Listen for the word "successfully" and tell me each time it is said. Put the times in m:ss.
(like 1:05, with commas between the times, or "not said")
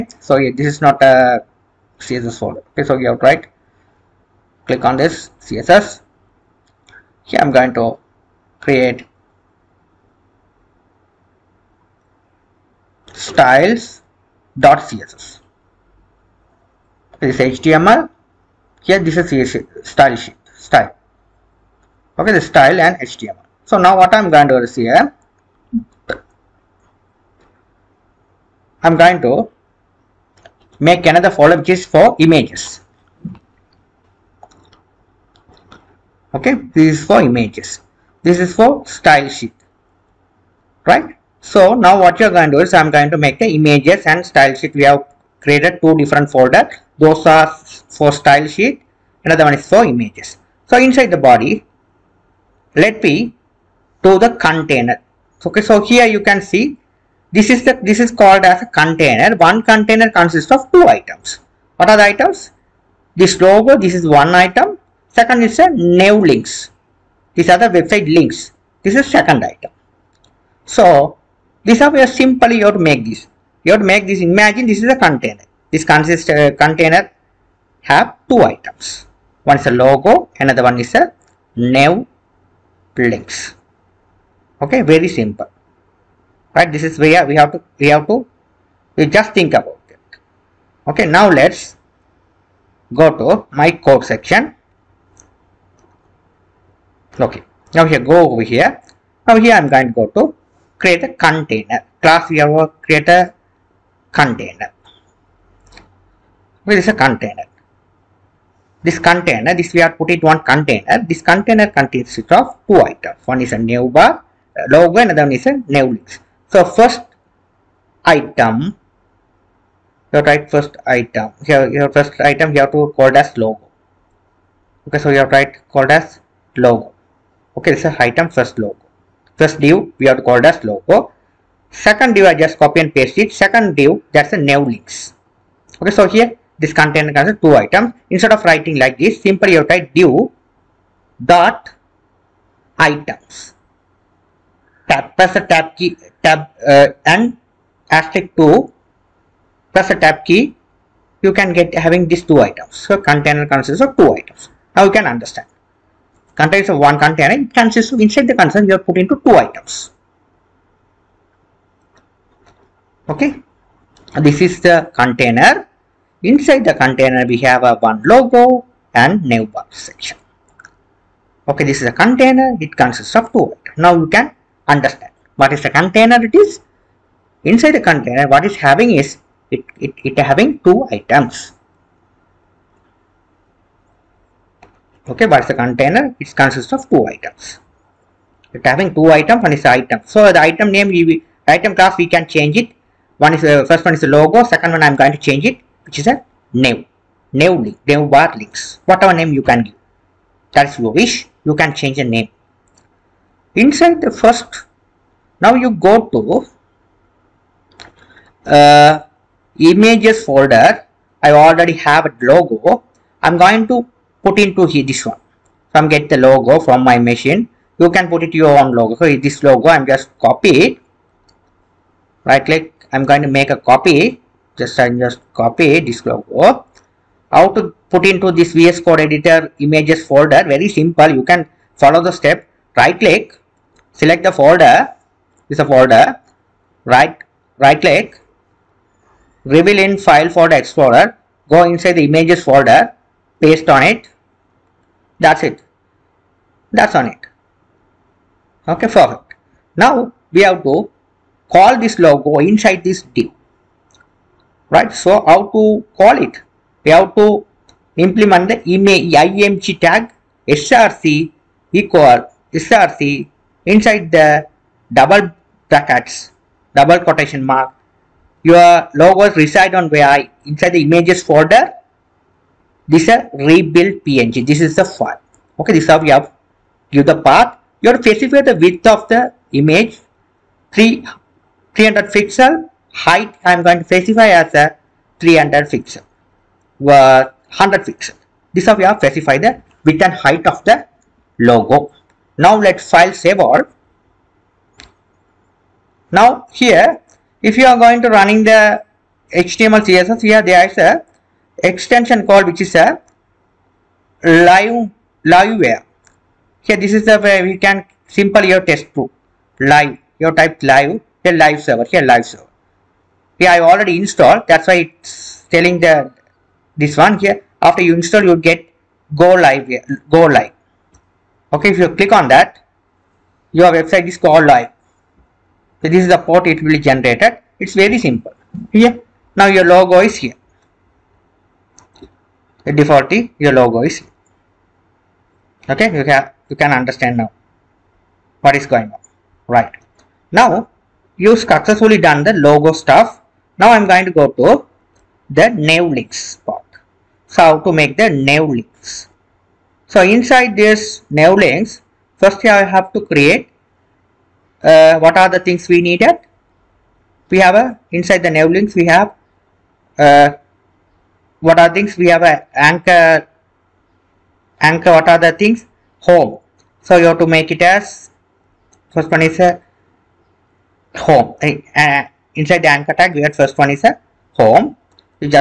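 5:41.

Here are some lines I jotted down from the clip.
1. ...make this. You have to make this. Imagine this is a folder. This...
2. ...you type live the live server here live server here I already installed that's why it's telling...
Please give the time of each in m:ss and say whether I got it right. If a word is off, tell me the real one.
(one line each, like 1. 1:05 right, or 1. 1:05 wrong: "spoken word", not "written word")
1. 1:12 wrong: "container", not "folder"
2. 5:10 right.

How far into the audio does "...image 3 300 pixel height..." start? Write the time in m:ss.
4:39.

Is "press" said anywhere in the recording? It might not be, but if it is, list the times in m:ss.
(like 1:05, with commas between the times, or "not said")
2:25, 2:29.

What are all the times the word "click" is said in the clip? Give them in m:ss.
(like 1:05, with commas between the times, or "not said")
0:04, 3:42, 3:52, 3:57, 5:21.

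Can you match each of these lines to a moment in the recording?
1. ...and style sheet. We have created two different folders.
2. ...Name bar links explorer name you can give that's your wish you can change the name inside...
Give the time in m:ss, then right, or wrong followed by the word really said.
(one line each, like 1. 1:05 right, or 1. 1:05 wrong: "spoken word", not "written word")
1. 0:44 right
2. 3:17 wrong: "whatever", not "explorer".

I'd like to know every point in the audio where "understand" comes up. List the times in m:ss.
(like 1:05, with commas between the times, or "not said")
2:35, 2:54, 5:36.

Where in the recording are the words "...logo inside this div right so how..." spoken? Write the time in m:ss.
4:11.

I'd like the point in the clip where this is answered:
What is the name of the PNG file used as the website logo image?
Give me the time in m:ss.
4:33.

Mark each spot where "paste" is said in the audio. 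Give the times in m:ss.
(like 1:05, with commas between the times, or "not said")
2:12, 4:03.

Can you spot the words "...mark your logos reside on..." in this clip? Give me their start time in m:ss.
4:27.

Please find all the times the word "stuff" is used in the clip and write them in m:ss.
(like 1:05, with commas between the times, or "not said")
5:42.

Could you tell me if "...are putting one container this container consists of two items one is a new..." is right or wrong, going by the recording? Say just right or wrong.
right.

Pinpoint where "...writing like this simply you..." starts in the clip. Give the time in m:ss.
2:18.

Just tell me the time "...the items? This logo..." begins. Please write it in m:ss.
1:01.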